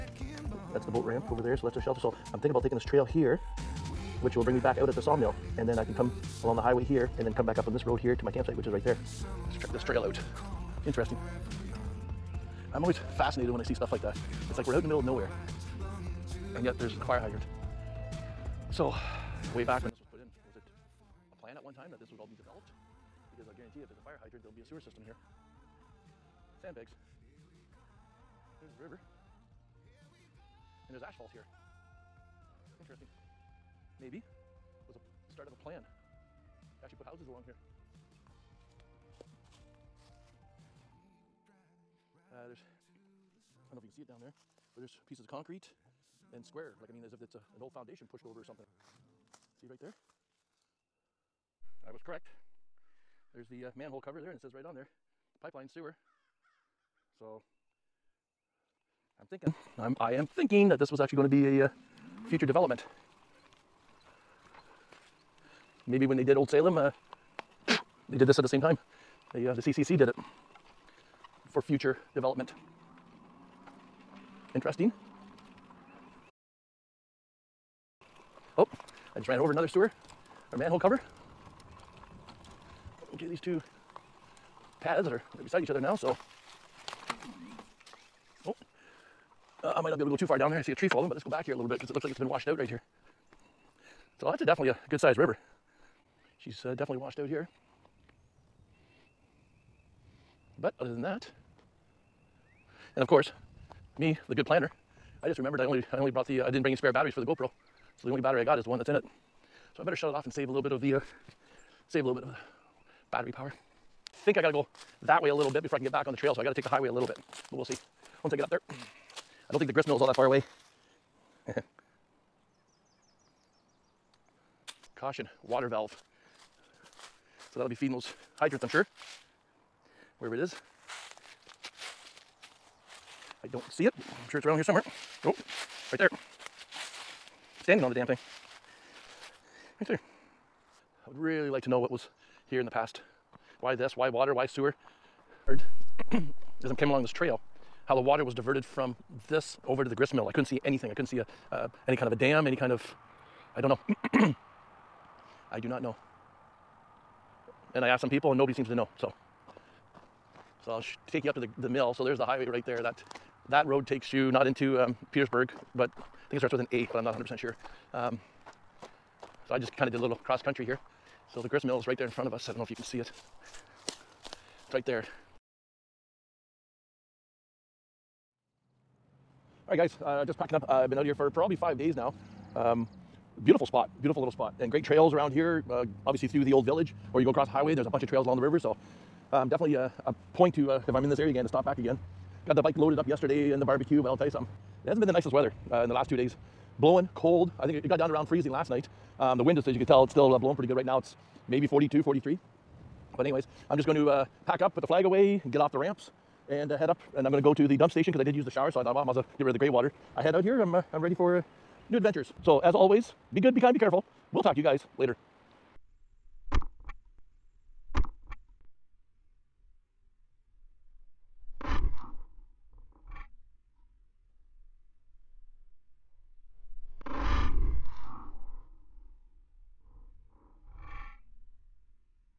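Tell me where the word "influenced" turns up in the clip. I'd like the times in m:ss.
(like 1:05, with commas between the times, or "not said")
not said.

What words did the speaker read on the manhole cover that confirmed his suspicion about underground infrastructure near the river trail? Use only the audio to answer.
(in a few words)
Pipeline sewer.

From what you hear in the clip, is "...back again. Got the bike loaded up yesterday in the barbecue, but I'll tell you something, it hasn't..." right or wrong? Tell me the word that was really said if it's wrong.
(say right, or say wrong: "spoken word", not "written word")
right.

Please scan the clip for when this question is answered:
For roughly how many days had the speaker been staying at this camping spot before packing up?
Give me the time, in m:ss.
3:01.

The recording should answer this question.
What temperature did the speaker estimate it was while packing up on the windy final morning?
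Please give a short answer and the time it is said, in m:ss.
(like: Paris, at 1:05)
42 to 43, at 3:21.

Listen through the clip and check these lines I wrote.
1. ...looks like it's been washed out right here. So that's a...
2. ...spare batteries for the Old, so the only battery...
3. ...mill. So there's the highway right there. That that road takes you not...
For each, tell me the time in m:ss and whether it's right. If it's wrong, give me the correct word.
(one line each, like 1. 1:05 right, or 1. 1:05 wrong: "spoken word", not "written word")
1. 1:31 right
2. 1:46 wrong: "GoPro", not "Old"
3. 2:41 right.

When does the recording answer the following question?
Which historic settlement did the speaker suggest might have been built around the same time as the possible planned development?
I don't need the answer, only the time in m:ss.
1:06.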